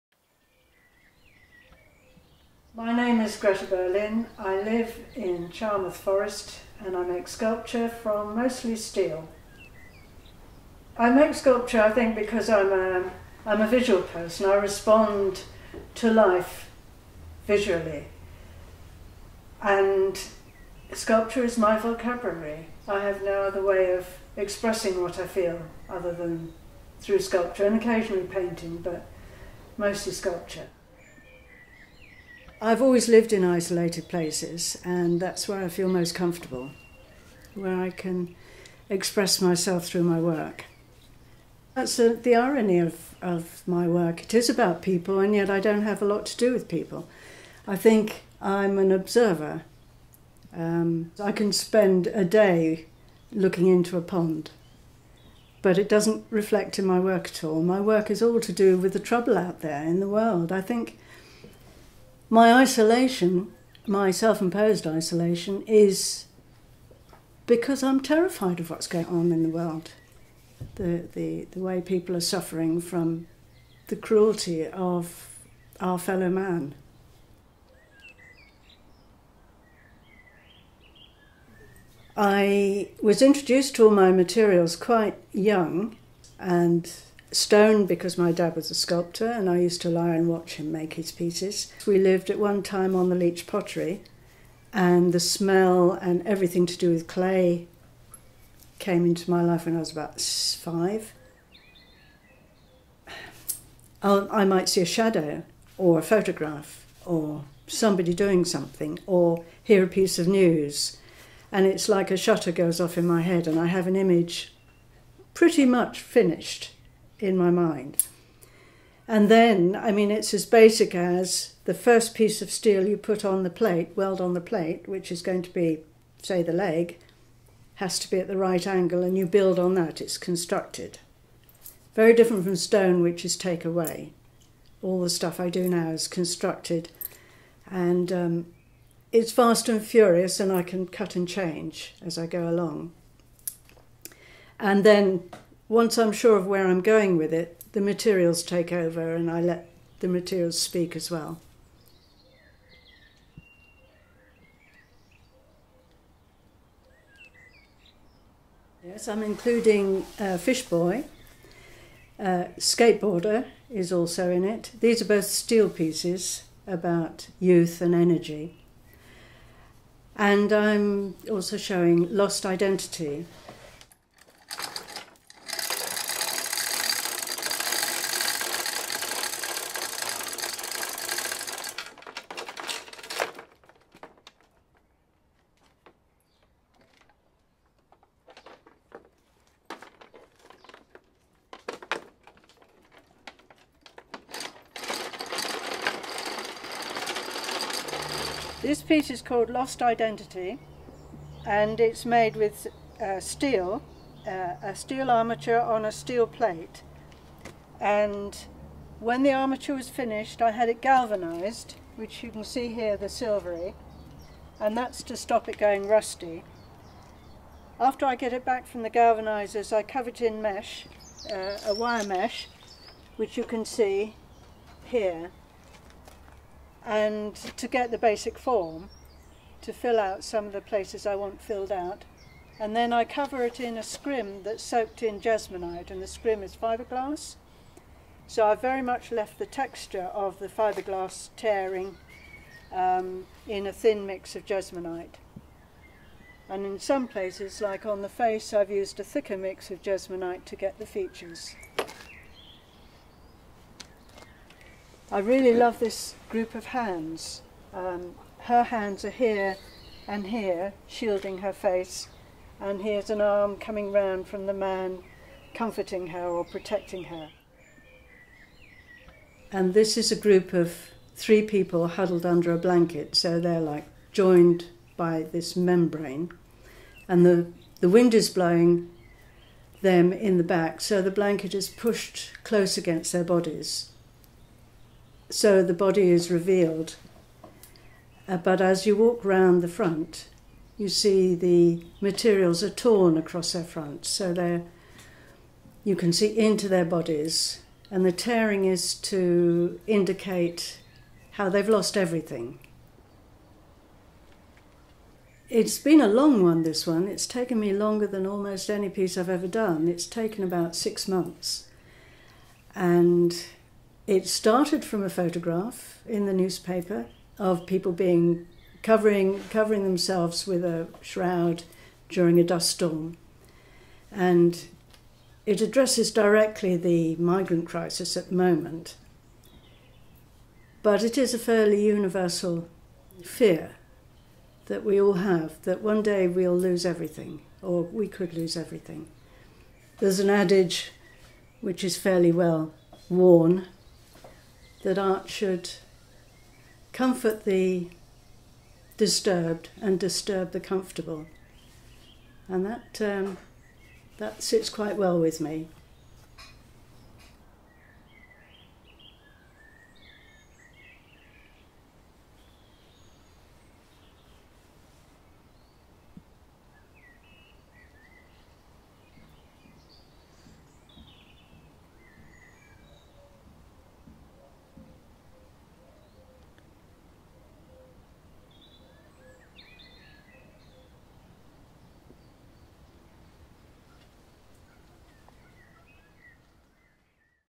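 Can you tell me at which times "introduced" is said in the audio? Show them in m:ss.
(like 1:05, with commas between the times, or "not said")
1:23.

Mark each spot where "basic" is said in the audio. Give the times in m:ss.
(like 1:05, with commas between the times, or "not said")
2:00, 3:47.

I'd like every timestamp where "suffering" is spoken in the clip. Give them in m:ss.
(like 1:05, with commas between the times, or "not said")
1:12.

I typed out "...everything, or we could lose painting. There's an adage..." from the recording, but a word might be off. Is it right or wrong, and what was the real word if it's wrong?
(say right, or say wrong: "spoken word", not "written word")
wrong: "everything", not "painting".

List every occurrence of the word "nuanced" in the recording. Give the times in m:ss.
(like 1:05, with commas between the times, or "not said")
not said.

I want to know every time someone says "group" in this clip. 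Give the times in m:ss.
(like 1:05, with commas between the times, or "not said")
4:16, 4:30.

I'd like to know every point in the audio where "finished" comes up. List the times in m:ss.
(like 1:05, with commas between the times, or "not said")
1:55, 3:29.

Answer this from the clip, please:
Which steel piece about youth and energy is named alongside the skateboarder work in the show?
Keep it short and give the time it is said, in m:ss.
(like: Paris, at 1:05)
Fish Boy, at 2:40.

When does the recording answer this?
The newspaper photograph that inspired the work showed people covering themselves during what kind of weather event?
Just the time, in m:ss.
5:22.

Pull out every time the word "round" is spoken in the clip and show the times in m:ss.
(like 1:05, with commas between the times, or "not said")
4:23, 4:49.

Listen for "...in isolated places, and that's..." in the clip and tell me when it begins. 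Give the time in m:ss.
0:33.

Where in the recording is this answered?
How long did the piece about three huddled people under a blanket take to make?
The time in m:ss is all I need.
5:10.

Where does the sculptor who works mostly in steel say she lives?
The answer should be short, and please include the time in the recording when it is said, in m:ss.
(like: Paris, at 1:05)
Charmouth Forest, at 0:05.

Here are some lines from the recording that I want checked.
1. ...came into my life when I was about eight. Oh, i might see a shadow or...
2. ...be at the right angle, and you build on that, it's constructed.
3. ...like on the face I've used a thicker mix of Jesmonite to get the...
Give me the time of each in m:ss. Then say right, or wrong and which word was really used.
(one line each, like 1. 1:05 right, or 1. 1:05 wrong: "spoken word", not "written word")
1. 1:38 wrong: "five", not "eight"
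2. 2:08 right
3. 4:07 right.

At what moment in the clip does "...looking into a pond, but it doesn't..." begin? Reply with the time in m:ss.
0:53.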